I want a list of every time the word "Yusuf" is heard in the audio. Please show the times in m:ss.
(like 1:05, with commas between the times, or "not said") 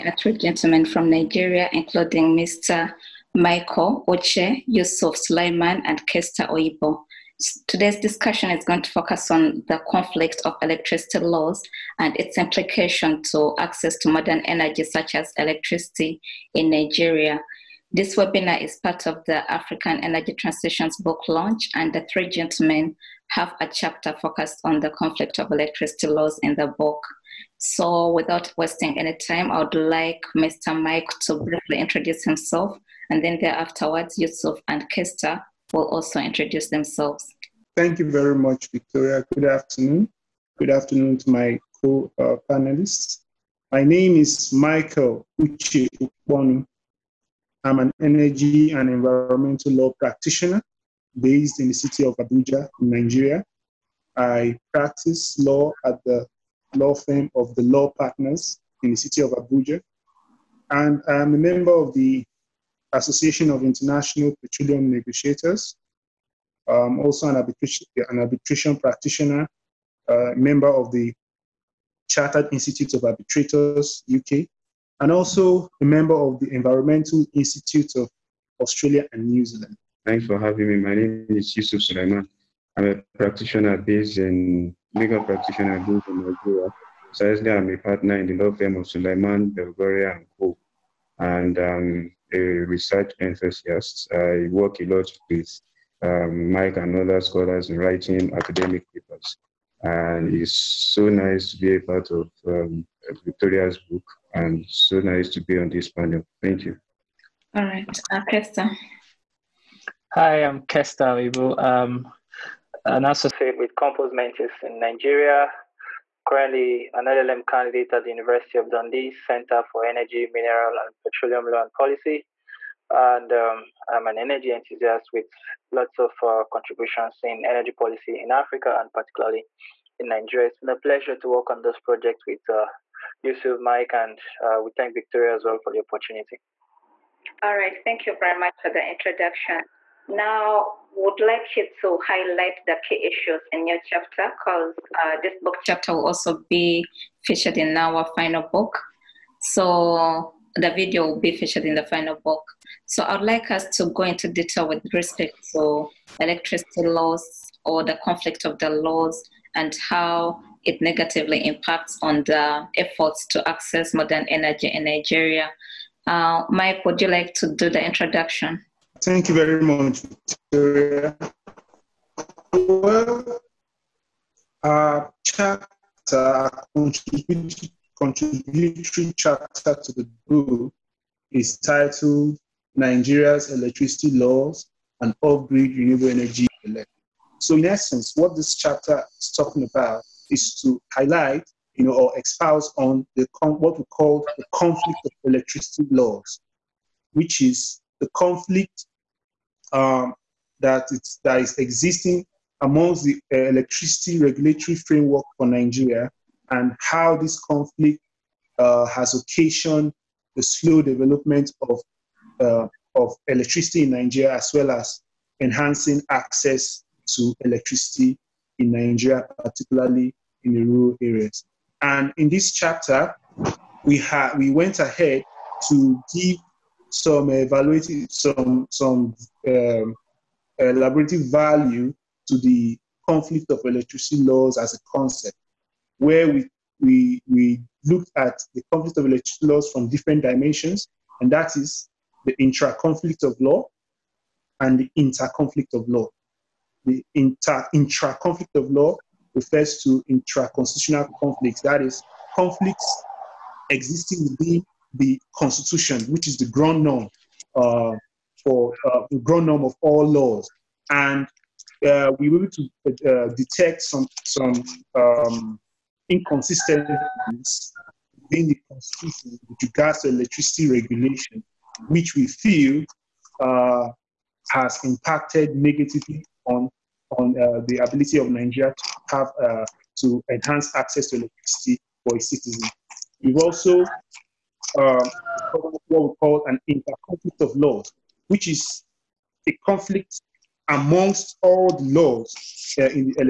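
0:04, 0:34, 1:21, 2:13.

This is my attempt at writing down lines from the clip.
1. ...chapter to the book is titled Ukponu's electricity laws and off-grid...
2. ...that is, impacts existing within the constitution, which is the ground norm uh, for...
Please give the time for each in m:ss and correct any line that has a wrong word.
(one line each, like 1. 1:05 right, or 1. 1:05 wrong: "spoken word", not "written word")
1. 2:59 wrong: "Nigeria", not "Ukponu"
2. 4:11 wrong: "conflicts", not "impacts".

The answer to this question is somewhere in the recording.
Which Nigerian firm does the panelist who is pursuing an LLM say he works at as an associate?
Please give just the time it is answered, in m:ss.
1:53.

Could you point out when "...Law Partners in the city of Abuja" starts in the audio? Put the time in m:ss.
0:57.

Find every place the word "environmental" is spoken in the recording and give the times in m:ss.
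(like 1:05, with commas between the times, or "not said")
0:48, 1:16.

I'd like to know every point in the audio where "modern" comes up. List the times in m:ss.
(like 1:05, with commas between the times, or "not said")
0:14, 2:43.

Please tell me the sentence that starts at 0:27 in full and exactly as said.
So, without wasting any time, I would like Mr.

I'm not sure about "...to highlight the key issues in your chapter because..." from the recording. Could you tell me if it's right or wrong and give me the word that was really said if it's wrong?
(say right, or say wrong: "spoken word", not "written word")
right.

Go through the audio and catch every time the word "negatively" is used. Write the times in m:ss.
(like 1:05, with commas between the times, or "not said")
2:40, 4:35.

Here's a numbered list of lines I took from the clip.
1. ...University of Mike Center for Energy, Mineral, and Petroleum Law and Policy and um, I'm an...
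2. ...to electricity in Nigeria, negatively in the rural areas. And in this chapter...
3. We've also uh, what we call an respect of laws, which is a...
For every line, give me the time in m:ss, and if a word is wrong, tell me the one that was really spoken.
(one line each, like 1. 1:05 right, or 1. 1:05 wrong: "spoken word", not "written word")
1. 1:58 wrong: "Dundee", not "Mike"
2. 3:37 wrong: "particularly", not "negatively"
3. 4:43 wrong: "interconflict", not "respect".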